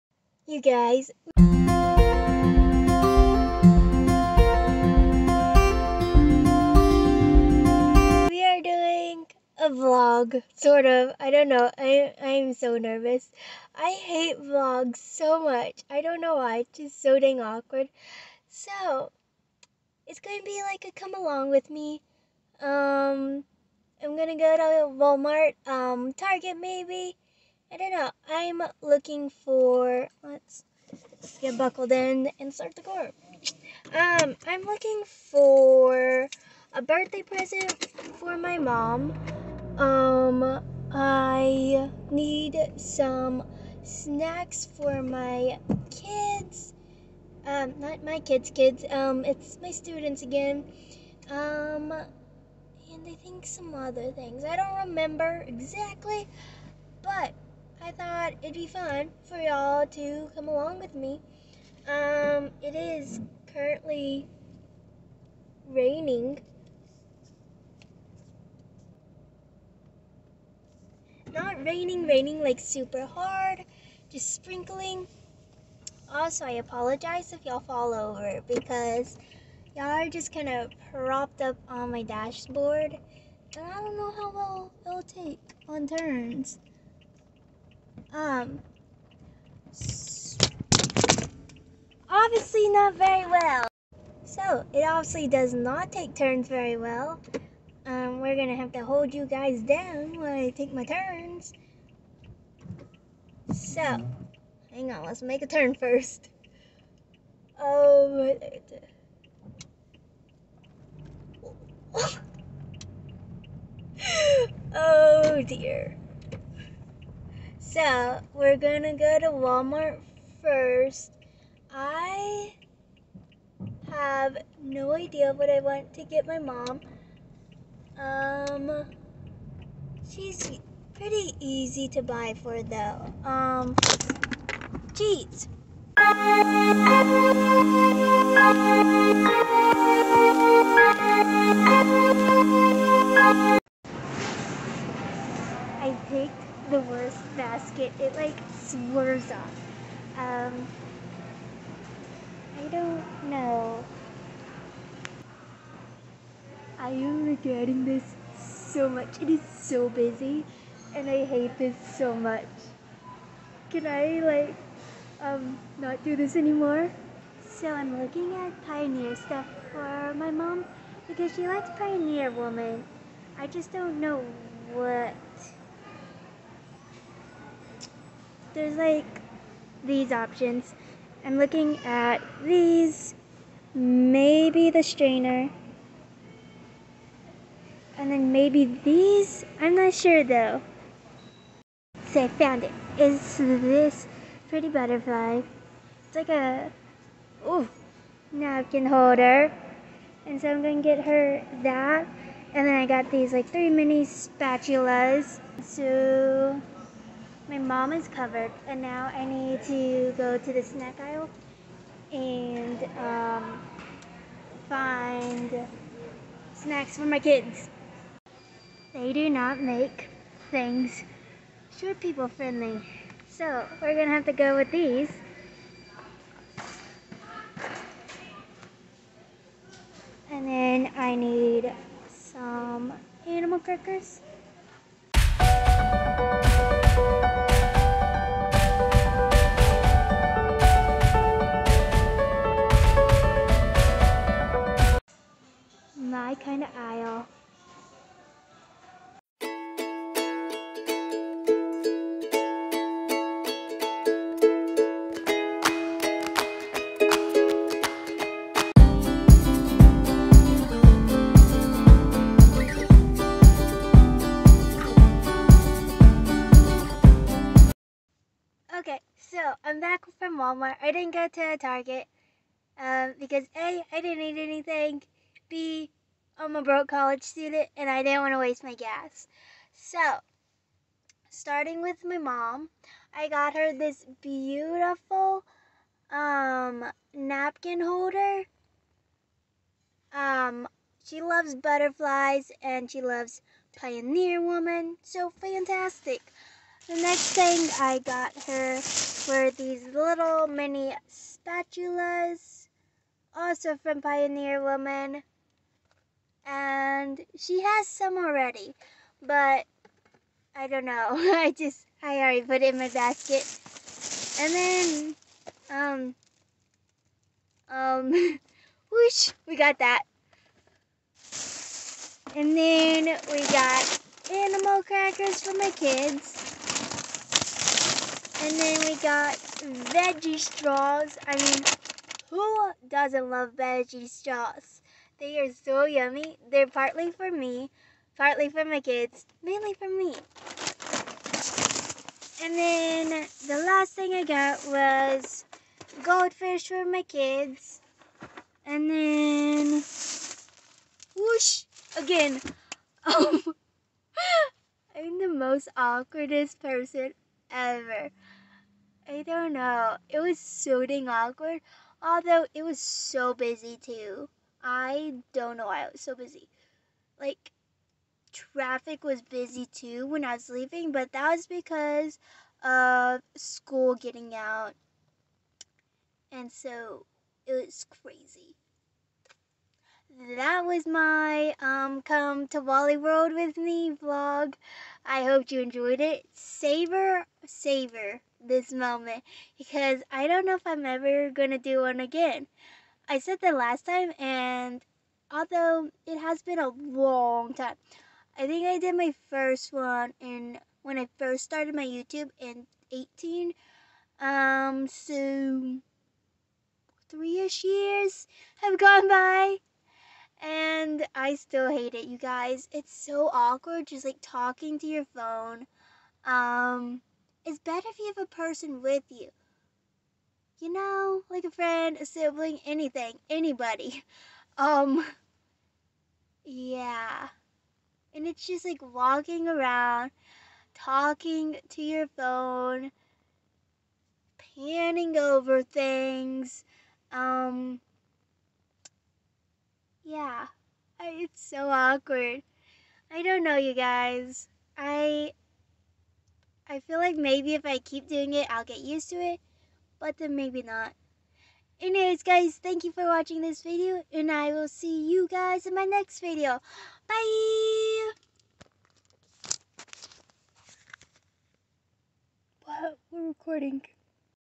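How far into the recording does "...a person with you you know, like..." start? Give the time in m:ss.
6:58.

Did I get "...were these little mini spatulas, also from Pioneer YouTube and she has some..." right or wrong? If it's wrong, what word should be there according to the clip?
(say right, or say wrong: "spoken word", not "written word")
wrong: "Woman", not "YouTube".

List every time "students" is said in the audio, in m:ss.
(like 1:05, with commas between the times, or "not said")
0:49, 4:37.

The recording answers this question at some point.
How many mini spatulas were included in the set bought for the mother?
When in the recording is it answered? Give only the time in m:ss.
3:23.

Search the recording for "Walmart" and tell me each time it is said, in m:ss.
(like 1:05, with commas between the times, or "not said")
0:25, 1:59, 4:30.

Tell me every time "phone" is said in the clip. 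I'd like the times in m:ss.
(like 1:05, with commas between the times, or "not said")
6:55, 7:12.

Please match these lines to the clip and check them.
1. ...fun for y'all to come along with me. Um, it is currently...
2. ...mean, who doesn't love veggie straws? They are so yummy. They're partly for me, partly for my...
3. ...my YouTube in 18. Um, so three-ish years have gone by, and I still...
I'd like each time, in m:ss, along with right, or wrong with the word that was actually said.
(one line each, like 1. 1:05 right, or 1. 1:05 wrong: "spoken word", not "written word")
1. 0:58 right
2. 5:31 right
3. 6:41 right.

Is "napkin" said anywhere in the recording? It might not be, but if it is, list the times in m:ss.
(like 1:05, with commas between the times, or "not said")
3:18, 4:47.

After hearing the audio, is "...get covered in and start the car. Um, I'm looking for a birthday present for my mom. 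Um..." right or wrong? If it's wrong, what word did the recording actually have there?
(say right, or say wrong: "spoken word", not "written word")
wrong: "buckled", not "covered".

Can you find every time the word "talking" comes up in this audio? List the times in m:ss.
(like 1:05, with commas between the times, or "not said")
6:54, 7:10.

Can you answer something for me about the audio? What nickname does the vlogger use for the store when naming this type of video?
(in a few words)
Wally World.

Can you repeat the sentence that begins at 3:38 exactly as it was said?
They do not make things short people friendly.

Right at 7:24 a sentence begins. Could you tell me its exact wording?
I I feel like maybe if I keep doing it, I'll get used to it but then maybe not.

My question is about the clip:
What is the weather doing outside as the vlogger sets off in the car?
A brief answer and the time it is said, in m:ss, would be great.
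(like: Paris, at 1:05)
Sprinkling, at 1:14.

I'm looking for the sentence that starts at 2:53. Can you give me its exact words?
I just don't know what there's like these options.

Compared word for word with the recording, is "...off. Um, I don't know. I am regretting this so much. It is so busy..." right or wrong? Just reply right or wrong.
right.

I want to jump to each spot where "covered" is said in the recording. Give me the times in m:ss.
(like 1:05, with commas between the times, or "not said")
3:28.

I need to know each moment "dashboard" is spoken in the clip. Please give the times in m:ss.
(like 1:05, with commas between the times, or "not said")
1:22.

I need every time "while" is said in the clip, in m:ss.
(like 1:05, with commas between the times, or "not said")
1:40.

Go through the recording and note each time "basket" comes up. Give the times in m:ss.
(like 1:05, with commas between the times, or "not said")
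2:27, 5:12.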